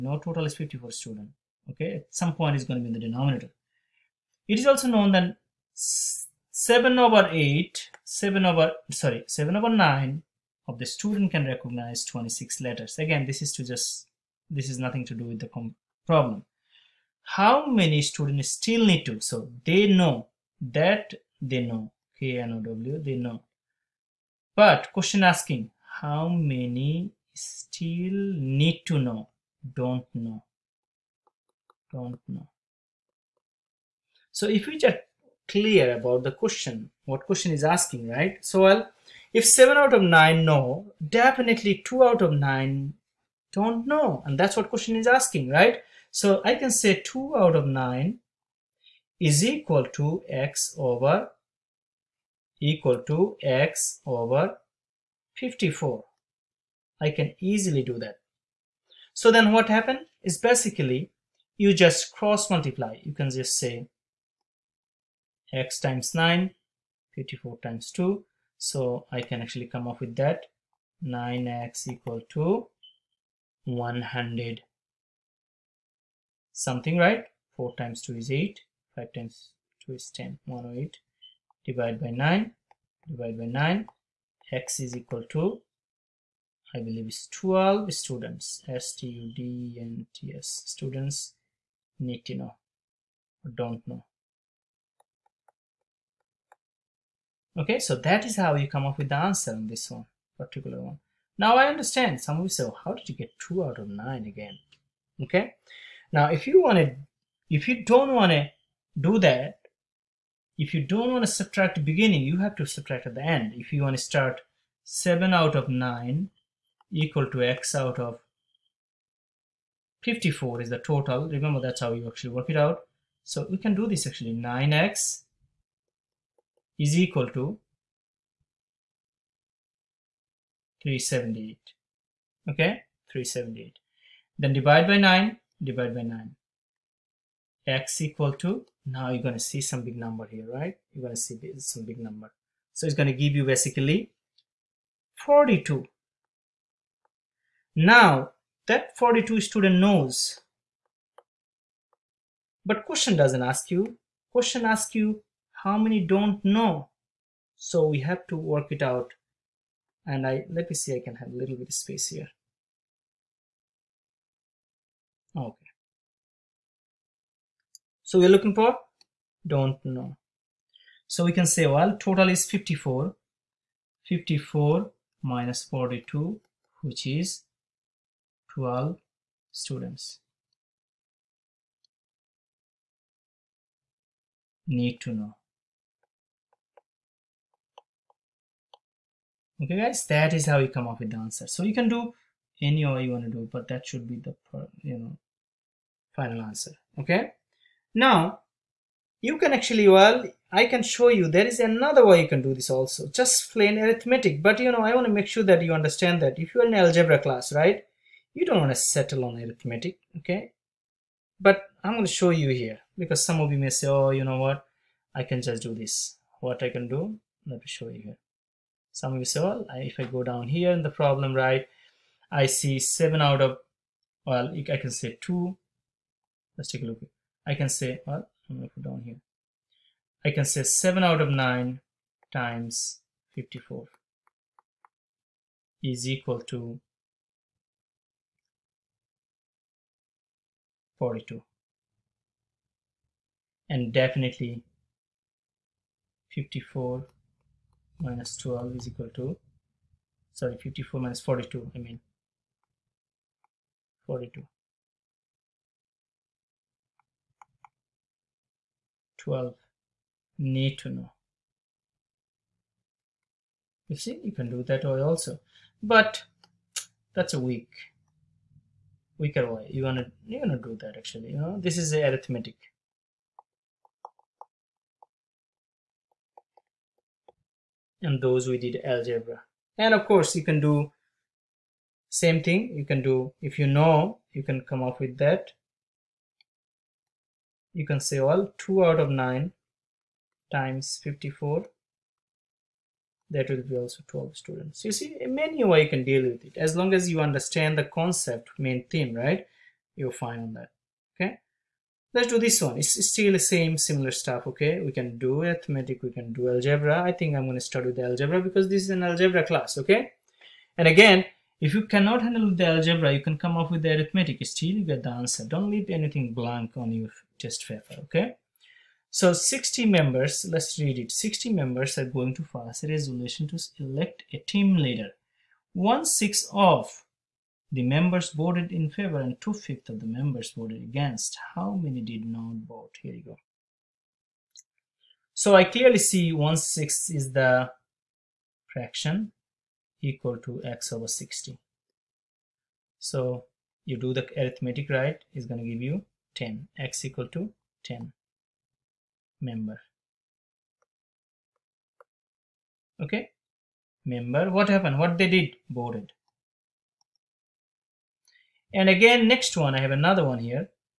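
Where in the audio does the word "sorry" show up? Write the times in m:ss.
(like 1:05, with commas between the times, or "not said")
0:08, 4:10.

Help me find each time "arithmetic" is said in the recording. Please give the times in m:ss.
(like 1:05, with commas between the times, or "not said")
3:23, 3:29, 4:31, 5:05, 5:13, 5:44.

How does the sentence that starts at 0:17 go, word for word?
How many students still need to?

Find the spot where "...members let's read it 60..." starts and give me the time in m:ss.
5:19.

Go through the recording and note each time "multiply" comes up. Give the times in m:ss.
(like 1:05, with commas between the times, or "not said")
1:02.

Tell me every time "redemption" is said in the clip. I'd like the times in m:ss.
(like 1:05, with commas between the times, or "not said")
not said.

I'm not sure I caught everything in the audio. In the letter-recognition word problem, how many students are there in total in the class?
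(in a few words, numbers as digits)
54.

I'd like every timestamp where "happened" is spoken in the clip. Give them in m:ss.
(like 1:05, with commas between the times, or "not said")
0:59, 5:54.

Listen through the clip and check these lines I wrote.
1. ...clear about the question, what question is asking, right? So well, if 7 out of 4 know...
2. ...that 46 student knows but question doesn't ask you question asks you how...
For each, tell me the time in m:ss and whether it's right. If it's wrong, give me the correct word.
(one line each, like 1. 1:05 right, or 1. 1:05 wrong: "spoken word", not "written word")
1. 0:35 wrong: "9", not "4"
2. 2:28 wrong: "42", not "46".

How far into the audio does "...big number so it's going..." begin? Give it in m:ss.
2:21.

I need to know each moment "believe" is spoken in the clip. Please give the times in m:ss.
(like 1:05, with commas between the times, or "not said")
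1:26.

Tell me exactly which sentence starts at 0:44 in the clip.
And that's what question is asking, right?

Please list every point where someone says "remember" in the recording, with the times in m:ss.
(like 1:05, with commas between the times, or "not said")
2:01.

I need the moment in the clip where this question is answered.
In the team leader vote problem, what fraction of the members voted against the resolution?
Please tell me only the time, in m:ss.
5:29.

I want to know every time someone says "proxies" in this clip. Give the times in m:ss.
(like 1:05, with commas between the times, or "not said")
not said.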